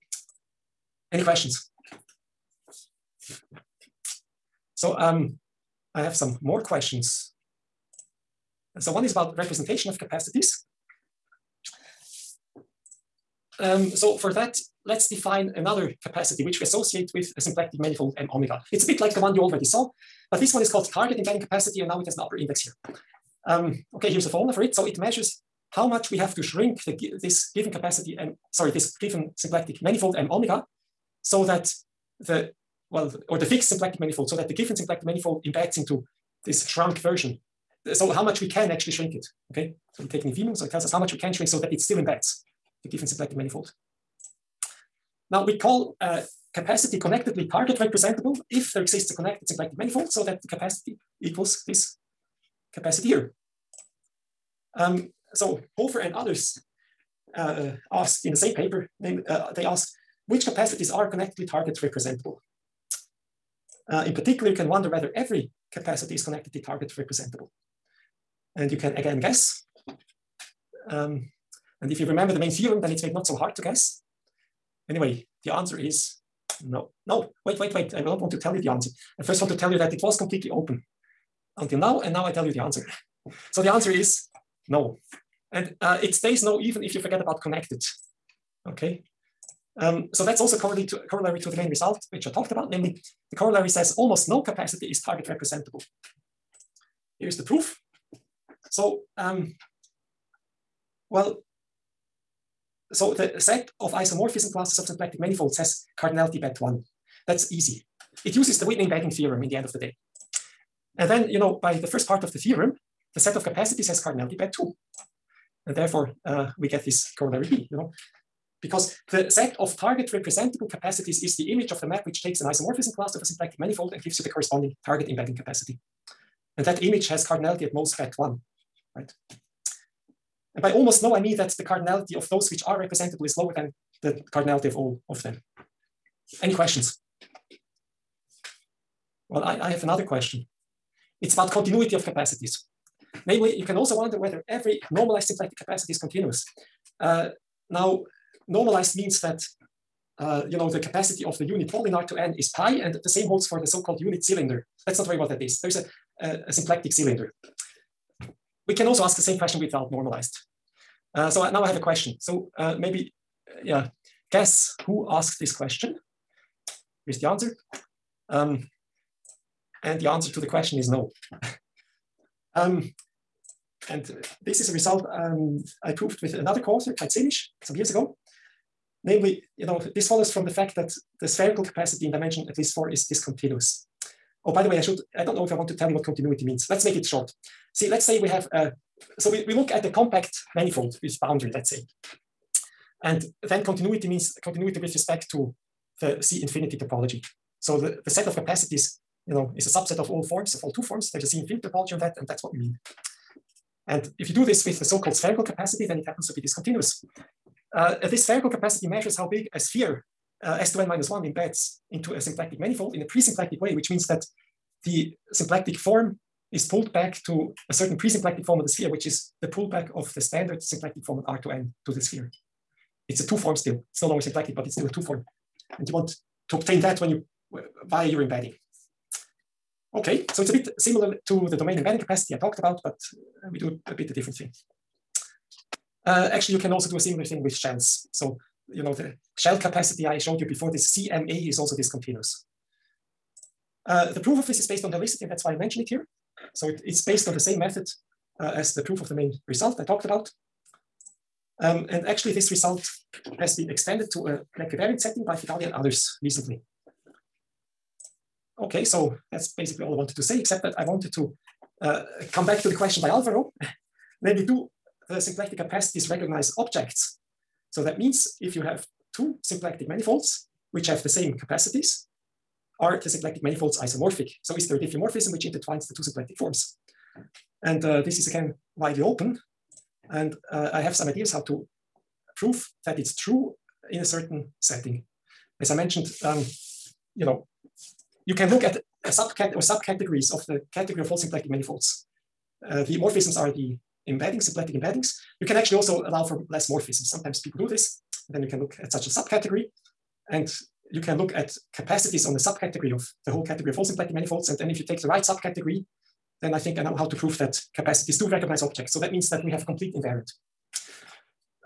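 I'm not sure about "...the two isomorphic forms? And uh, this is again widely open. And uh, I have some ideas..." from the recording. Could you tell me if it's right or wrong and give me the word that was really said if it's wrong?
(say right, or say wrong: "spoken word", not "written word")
wrong: "symplectic", not "isomorphic".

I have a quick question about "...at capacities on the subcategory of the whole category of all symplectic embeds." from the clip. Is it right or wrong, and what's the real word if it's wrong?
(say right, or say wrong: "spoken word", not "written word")
wrong: "manifolds", not "embeds".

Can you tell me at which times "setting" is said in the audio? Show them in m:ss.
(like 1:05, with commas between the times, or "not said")
4:14, 4:44.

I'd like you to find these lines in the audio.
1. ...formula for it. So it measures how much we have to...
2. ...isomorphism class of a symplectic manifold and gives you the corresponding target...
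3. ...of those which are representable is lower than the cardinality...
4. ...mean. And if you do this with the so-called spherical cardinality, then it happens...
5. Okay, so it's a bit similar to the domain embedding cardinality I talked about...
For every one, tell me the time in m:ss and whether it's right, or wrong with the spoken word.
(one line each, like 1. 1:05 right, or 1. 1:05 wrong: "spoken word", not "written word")
1. 0:24 right
2. 2:02 right
3. 2:12 right
4. 3:22 wrong: "capacity", not "cardinality"
5. 3:49 wrong: "capacity", not "cardinality".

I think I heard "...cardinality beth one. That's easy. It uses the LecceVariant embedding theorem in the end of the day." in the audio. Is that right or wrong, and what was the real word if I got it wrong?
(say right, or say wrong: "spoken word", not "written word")
wrong: "Whitney", not "LecceVariant".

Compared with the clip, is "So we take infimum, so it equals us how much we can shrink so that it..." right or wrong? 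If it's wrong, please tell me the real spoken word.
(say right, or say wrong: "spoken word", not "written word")
wrong: "tells", not "equals".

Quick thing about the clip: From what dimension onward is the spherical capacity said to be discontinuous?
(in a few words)
at least 4.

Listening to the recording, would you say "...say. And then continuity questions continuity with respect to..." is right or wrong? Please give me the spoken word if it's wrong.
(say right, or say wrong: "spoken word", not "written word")
wrong: "means", not "questions".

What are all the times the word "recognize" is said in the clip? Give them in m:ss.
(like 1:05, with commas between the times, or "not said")
4:26, 5:08.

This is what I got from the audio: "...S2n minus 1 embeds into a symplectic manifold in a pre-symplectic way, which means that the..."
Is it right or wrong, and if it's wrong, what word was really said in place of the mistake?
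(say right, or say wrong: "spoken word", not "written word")
right.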